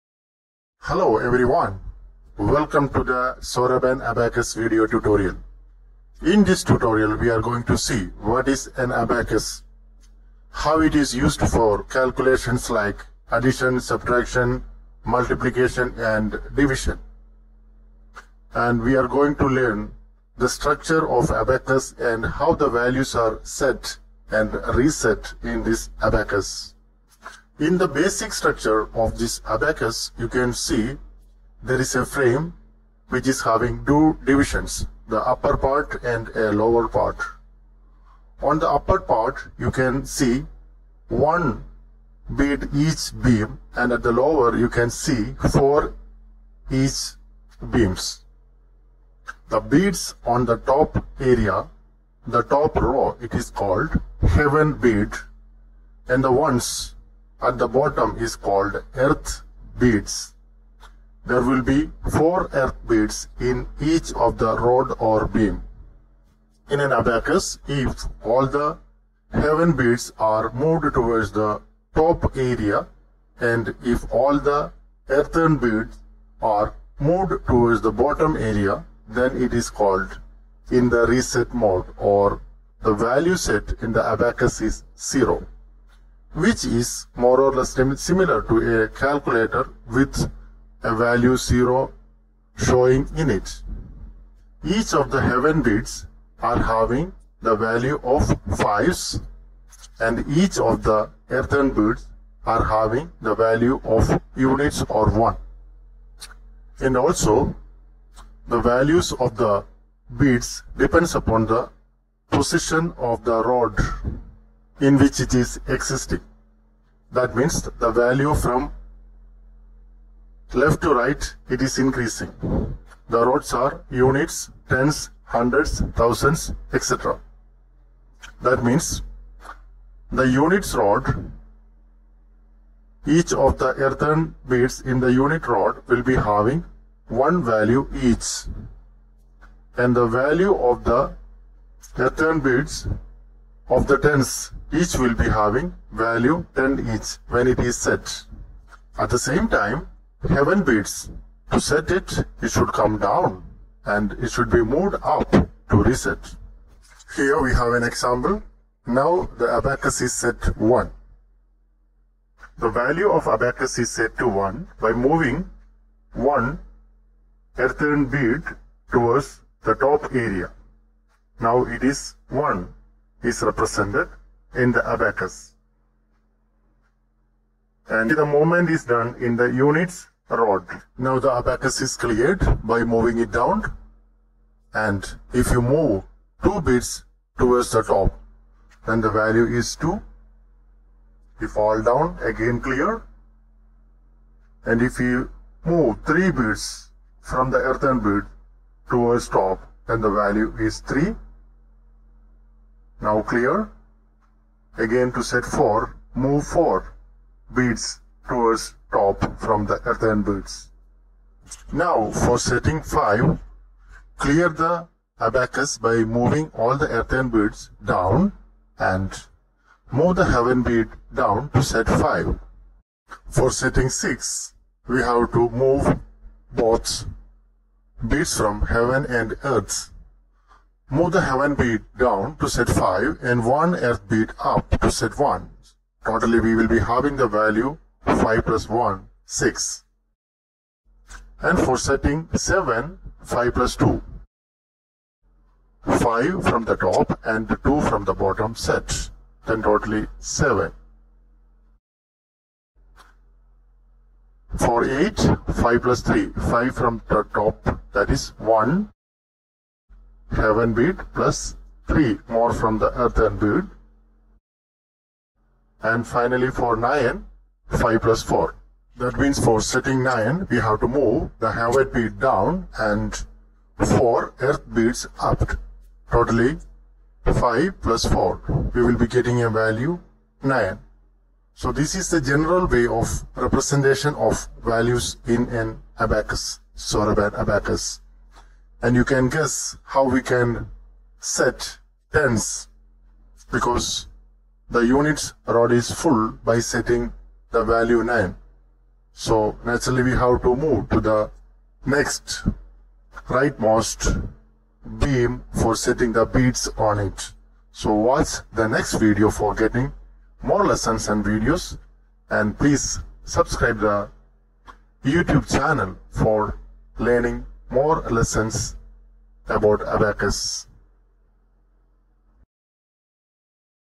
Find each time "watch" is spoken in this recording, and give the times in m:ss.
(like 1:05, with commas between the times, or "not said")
5:07.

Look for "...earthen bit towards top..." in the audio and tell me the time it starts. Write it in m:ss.
3:17.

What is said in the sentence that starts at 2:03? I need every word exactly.
The rods are units, tens, hundreds, thousands, etc.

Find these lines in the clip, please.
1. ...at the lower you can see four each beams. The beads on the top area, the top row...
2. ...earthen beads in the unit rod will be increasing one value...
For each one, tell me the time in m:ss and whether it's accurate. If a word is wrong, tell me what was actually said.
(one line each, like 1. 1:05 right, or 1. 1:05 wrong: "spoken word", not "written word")
1. 0:43 right
2. 2:13 wrong: "having", not "increasing".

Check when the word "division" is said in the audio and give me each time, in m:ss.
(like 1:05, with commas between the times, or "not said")
0:16, 0:34.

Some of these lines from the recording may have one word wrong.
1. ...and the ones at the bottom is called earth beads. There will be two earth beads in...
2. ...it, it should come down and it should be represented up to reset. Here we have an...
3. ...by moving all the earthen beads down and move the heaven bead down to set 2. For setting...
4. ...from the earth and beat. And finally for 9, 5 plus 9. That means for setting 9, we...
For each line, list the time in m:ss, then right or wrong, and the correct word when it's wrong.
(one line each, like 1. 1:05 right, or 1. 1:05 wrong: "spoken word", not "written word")
1. 0:56 wrong: "four", not "two"
2. 2:31 wrong: "moved", not "represented"
3. 3:35 wrong: "5", not "2"
4. 4:22 wrong: "4", not "9".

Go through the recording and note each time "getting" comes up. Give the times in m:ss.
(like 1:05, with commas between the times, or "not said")
4:39, 5:09.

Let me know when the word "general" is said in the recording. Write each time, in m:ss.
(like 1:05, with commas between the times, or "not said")
4:42.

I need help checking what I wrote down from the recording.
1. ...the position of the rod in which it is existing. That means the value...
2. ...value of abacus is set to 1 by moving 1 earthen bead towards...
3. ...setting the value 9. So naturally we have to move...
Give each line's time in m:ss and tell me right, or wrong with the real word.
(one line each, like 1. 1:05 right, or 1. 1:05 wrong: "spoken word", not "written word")
1. 1:51 right
2. 2:42 right
3. 4:56 right.